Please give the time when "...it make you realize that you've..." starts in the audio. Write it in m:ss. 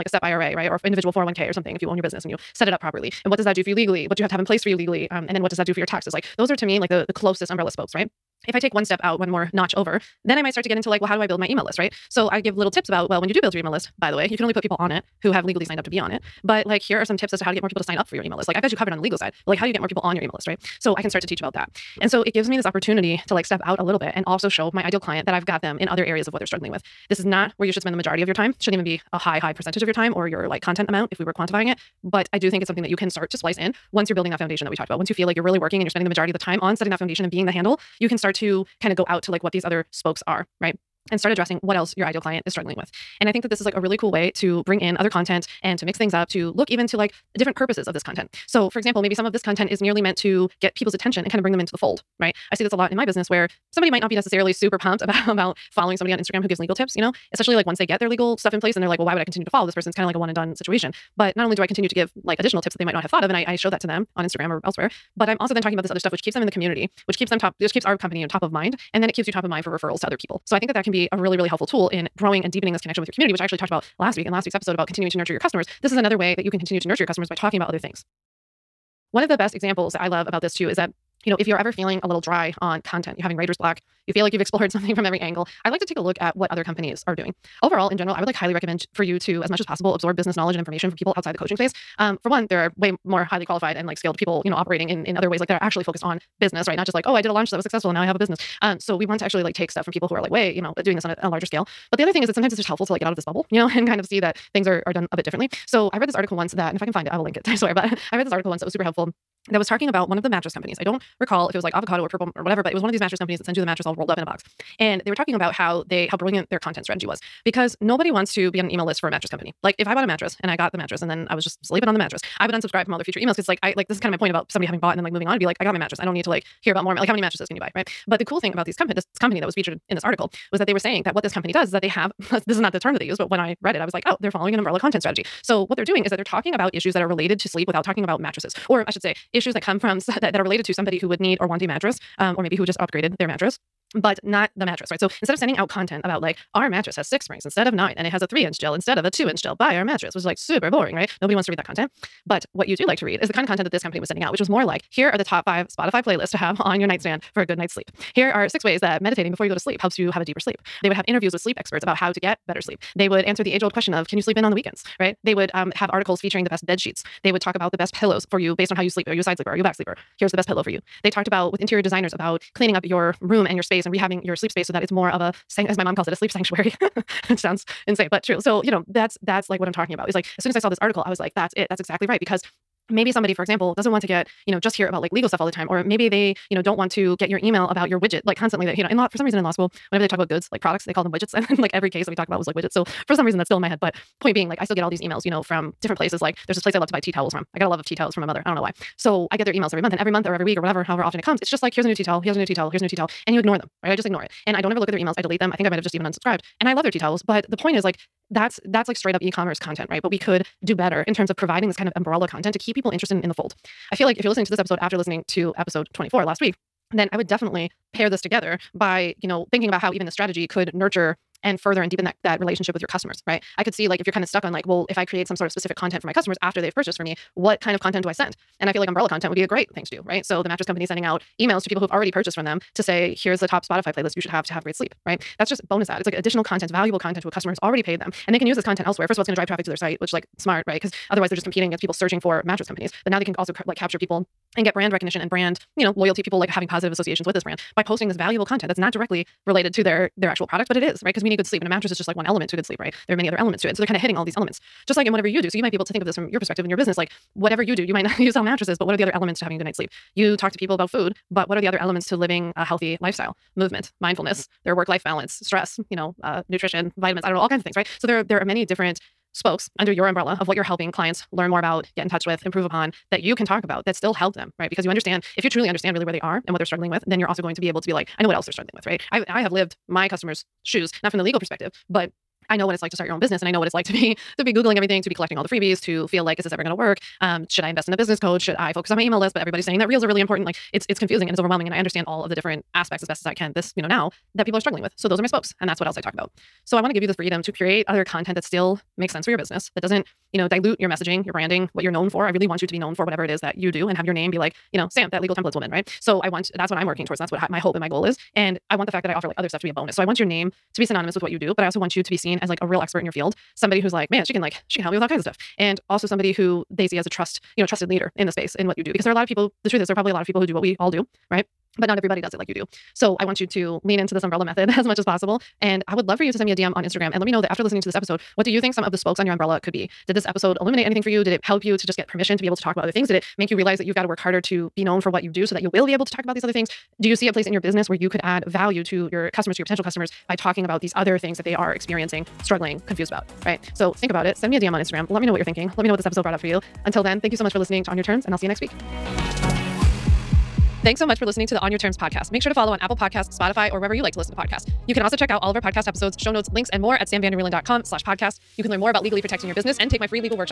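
5:33.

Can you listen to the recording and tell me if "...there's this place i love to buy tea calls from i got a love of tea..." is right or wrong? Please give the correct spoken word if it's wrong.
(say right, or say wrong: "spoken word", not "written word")
wrong: "towels", not "calls".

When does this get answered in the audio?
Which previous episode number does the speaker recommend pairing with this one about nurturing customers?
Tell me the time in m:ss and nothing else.
3:35.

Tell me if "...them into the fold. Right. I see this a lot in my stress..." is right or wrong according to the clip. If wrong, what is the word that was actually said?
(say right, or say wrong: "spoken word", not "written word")
wrong: "business", not "stress".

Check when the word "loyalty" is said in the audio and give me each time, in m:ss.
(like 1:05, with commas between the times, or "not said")
4:05.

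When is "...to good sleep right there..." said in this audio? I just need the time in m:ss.
4:12.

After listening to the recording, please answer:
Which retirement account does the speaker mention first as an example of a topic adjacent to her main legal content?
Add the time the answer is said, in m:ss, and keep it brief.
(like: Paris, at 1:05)
SEP IRA, at 0:00.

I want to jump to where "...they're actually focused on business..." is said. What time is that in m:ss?
1:35.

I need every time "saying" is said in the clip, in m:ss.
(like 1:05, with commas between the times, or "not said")
2:10, 4:49.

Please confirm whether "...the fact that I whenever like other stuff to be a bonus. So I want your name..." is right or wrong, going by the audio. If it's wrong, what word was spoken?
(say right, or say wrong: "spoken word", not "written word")
wrong: "offer", not "whenever".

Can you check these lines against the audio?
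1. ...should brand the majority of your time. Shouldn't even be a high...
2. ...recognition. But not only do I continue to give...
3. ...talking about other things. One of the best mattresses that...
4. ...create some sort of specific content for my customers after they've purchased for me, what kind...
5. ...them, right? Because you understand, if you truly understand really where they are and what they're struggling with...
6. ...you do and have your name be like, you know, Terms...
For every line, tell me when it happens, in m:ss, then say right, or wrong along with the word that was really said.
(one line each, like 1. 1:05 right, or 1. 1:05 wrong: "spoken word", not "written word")
1. 0:27 wrong: "spend", not "brand"
2. 1:00 wrong: "situation", not "recognition"
3. 1:17 wrong: "examples", not "mattresses"
4. 3:45 right
5. 4:34 right
6. 5:03 wrong: "Sam", not "Terms".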